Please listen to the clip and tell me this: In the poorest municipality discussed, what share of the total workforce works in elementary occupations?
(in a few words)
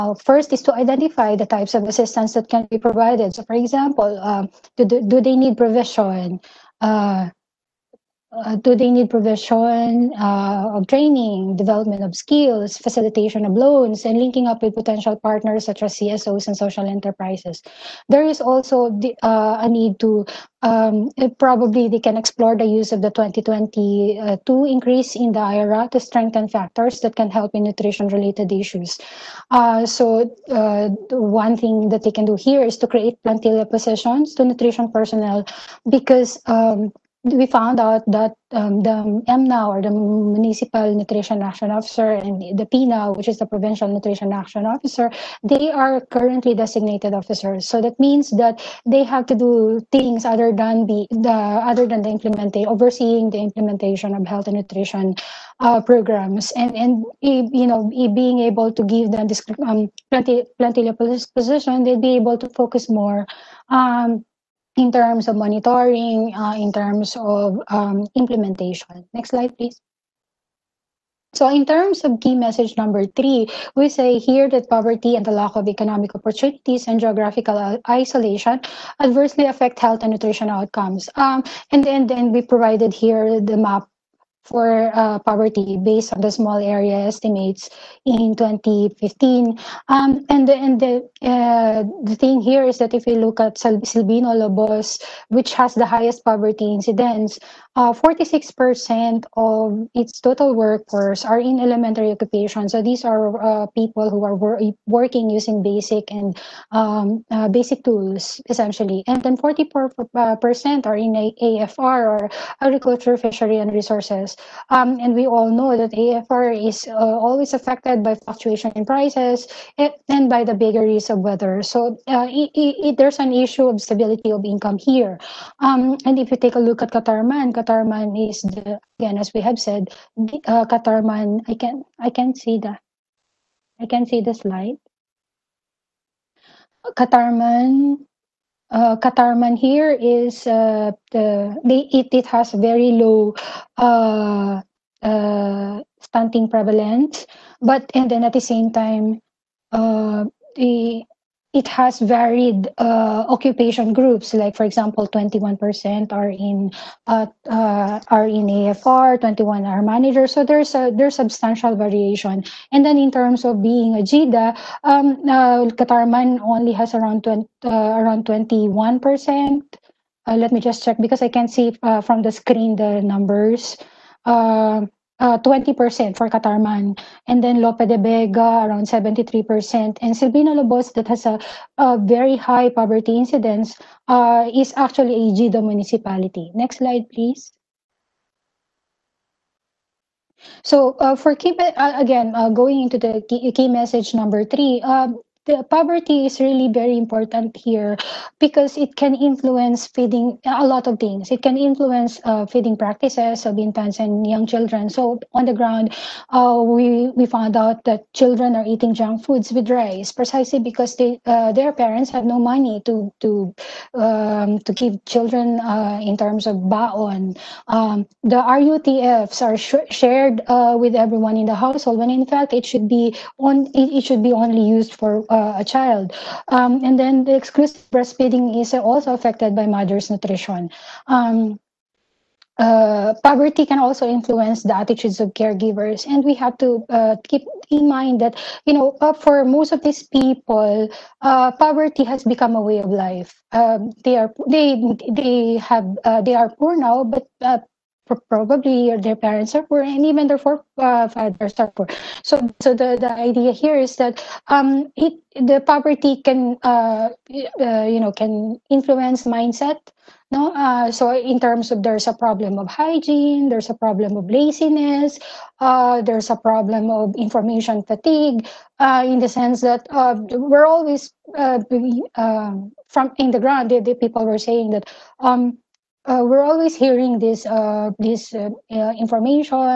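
46%.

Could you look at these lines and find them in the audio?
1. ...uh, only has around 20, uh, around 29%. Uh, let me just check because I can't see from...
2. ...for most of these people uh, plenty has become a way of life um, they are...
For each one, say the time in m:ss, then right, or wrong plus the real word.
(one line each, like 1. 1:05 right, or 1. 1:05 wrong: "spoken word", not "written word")
1. 2:46 wrong: "21", not "29"
2. 3:59 wrong: "poverty", not "plenty".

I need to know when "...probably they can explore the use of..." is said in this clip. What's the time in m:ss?
0:21.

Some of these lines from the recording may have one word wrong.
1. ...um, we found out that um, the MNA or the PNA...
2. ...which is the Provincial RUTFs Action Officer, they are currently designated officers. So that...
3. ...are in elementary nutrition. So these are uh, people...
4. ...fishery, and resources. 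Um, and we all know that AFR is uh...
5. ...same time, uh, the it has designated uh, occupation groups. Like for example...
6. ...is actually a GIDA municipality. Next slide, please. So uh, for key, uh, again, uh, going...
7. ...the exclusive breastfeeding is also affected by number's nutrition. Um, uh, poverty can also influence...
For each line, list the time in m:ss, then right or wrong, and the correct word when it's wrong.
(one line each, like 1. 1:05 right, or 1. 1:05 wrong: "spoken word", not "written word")
1. 0:36 wrong: "Municipal", not "PNA"
2. 0:43 wrong: "Nutrition", not "RUTFs"
3. 1:41 wrong: "occupation", not "nutrition"
4. 1:53 right
5. 2:28 wrong: "varied", not "designated"
6. 3:04 right
7. 3:47 wrong: "mother", not "number".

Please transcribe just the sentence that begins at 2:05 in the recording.
Um, and if you take a look at Catarman, Catarman is the again as we have said, uh, Catarman.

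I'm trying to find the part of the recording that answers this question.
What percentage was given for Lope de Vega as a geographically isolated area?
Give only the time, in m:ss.
2:58.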